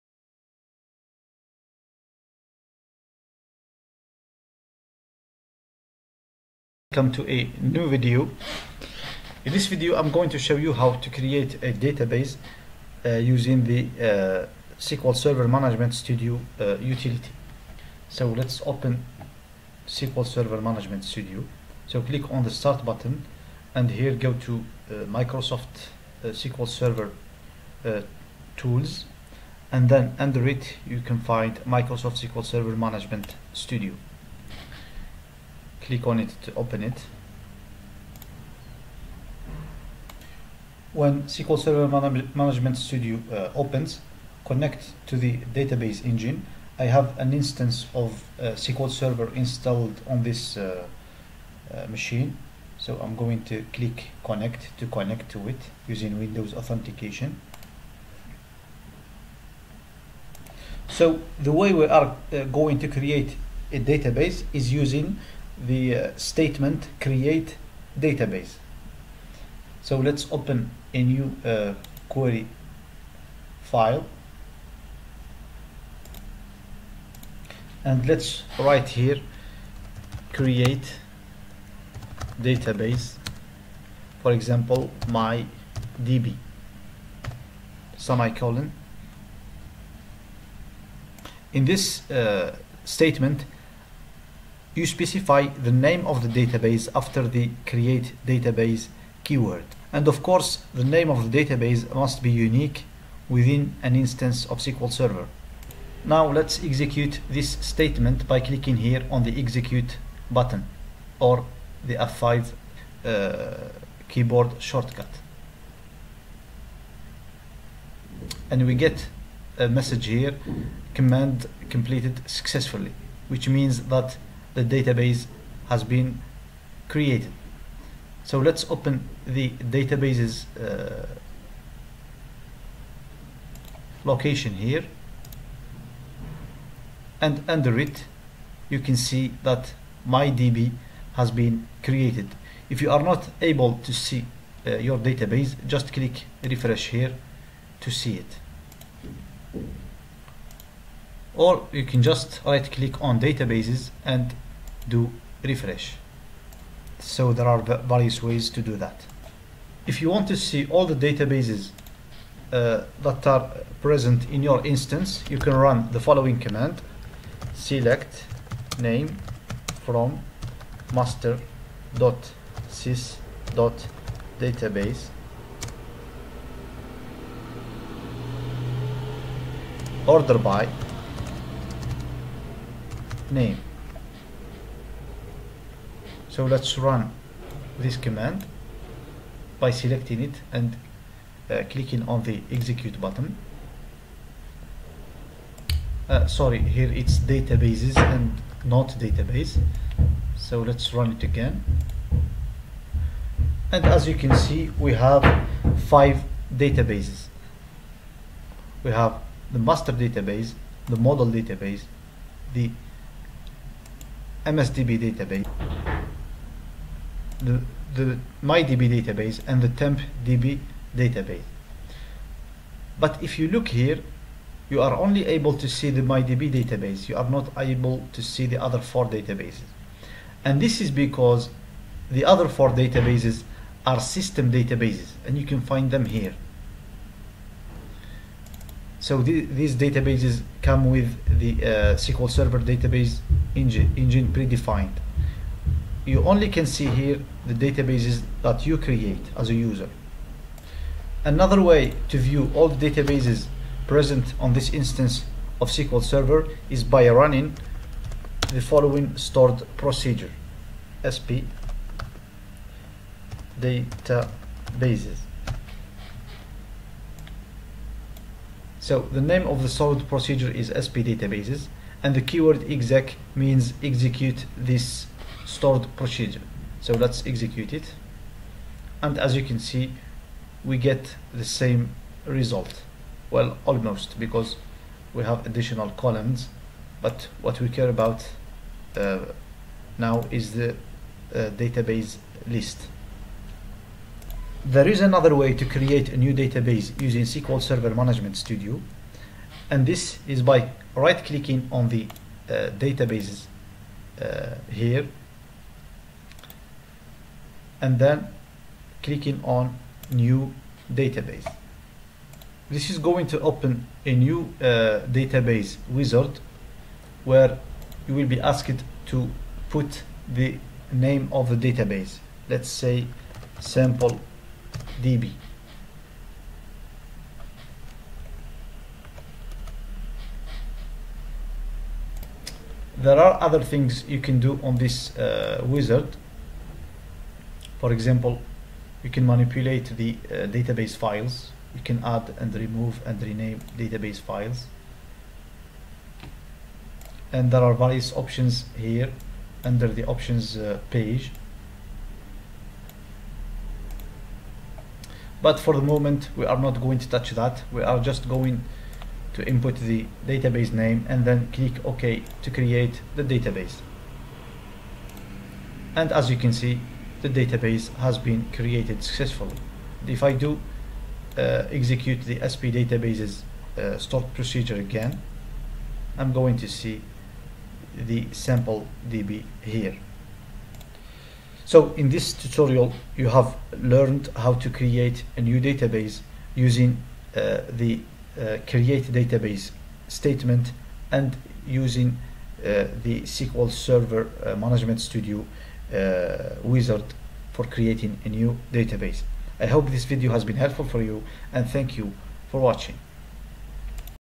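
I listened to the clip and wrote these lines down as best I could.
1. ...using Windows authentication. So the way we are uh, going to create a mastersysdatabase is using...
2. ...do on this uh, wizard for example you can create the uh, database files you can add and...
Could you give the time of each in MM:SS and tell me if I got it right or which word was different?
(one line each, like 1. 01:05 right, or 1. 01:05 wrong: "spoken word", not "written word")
1. 00:55 wrong: "database", not "mastersysdatabase"
2. 05:34 wrong: "manipulate", not "create".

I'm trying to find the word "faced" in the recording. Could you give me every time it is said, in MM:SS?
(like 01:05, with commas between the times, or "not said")
not said.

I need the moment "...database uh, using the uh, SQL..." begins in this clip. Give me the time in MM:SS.
00:11.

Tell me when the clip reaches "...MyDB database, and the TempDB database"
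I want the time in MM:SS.
03:38.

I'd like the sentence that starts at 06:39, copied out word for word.
I hope this video has been helpful for you and thank you for watching.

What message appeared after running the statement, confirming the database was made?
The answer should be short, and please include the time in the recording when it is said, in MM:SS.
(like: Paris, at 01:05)
command completed successfully, at 02:00.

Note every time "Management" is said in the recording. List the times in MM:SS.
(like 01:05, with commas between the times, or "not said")
00:15, 00:20, 00:32, 00:42, 04:57, 06:34.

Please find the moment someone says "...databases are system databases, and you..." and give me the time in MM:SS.
03:52.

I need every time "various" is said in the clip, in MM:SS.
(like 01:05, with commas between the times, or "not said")
02:37, 05:47.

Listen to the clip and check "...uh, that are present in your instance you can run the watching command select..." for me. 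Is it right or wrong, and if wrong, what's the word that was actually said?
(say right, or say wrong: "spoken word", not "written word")
wrong: "following", not "watching".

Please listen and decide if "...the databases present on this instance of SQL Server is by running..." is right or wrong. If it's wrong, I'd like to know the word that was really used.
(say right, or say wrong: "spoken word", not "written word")
right.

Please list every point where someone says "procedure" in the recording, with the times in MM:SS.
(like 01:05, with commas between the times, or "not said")
04:19, 04:30, 04:35, 06:14.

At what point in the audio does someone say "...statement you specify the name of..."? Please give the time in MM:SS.
01:32.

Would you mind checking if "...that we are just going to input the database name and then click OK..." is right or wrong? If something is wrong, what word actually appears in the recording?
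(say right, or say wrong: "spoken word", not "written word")
right.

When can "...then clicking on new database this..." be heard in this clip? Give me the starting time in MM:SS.
05:07.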